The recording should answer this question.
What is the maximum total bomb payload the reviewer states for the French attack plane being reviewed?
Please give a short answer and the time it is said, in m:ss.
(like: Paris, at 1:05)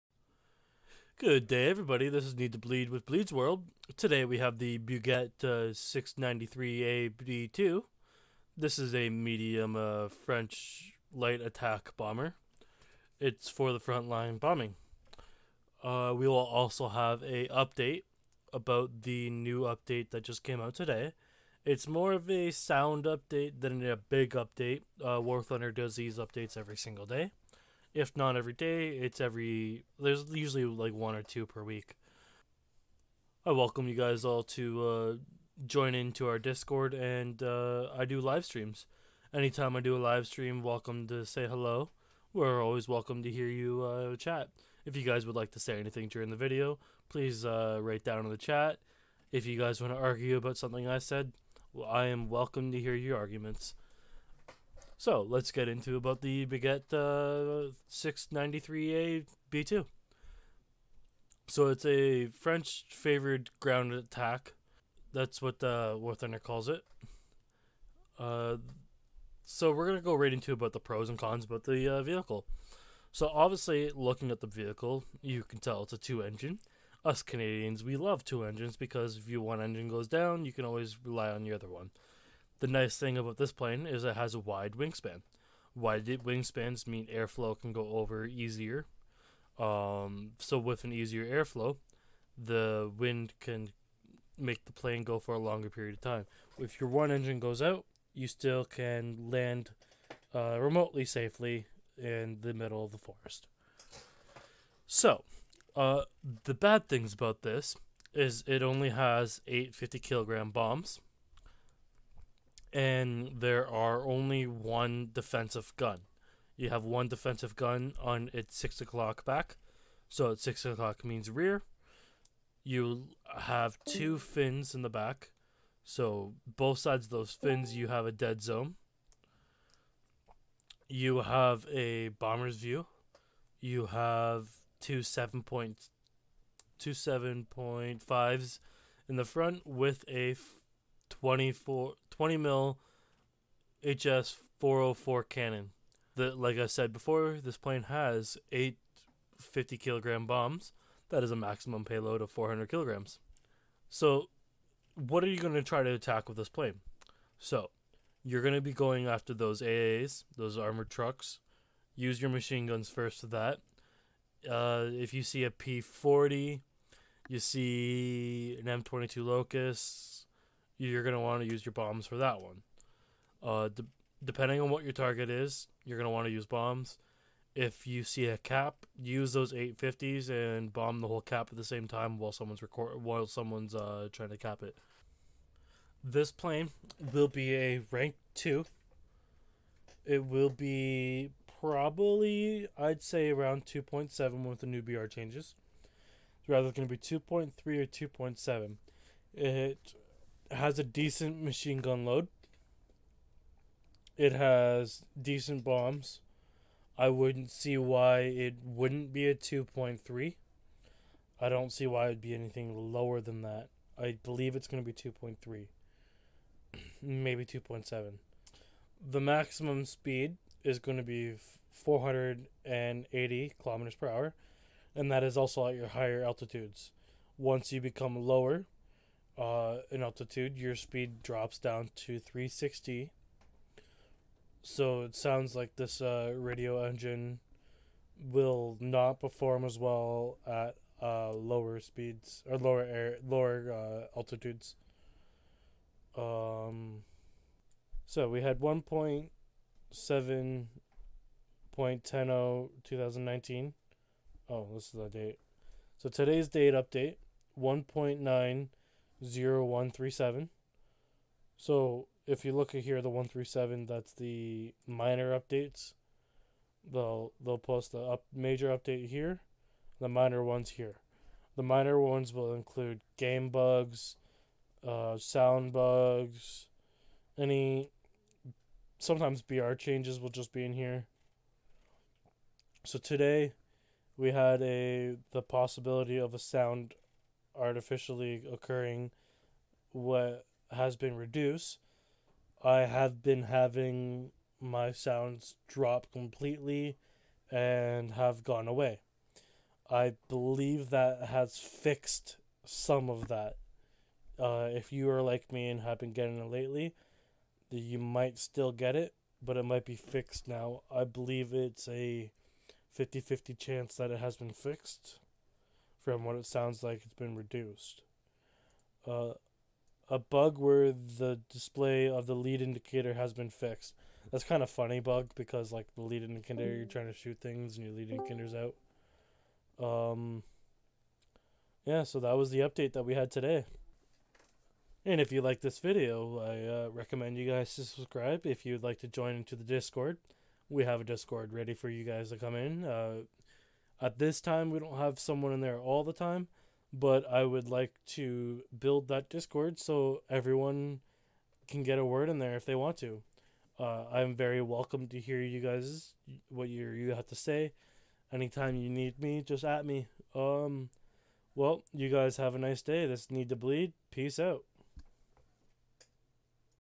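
400 kilograms, at 2:31.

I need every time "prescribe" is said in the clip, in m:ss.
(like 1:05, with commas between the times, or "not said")
not said.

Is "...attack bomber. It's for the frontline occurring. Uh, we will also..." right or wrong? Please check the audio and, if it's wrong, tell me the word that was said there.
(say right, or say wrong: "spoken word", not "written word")
wrong: "bombing", not "occurring".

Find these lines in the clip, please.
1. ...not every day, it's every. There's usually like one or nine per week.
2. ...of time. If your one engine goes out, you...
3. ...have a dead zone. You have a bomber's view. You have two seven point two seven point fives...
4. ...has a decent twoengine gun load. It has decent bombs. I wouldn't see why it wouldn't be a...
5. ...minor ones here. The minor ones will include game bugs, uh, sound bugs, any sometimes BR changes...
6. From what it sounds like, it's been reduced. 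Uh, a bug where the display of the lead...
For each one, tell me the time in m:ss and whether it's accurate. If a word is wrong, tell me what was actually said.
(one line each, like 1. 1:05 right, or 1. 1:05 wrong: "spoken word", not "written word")
1. 0:28 wrong: "two", not "nine"
2. 1:35 right
3. 2:07 right
4. 3:20 wrong: "machine", not "twoengine"
5. 4:30 right
6. 5:16 right.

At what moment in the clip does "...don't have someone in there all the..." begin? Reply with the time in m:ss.
5:44.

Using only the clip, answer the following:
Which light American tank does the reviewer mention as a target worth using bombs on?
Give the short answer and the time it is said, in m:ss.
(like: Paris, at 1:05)
M22 Locust, at 2:48.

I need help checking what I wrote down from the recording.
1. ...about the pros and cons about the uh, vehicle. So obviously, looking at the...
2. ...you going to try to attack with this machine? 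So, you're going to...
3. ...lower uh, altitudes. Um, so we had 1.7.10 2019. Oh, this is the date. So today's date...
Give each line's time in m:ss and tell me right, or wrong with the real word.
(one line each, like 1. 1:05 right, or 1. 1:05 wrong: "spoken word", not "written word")
1. 1:10 right
2. 2:35 wrong: "plane", not "machine"
3. 4:03 right.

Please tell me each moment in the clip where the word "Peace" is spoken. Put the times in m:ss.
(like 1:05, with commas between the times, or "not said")
6:04.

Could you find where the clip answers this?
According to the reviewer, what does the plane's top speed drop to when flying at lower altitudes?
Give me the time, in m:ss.
3:52.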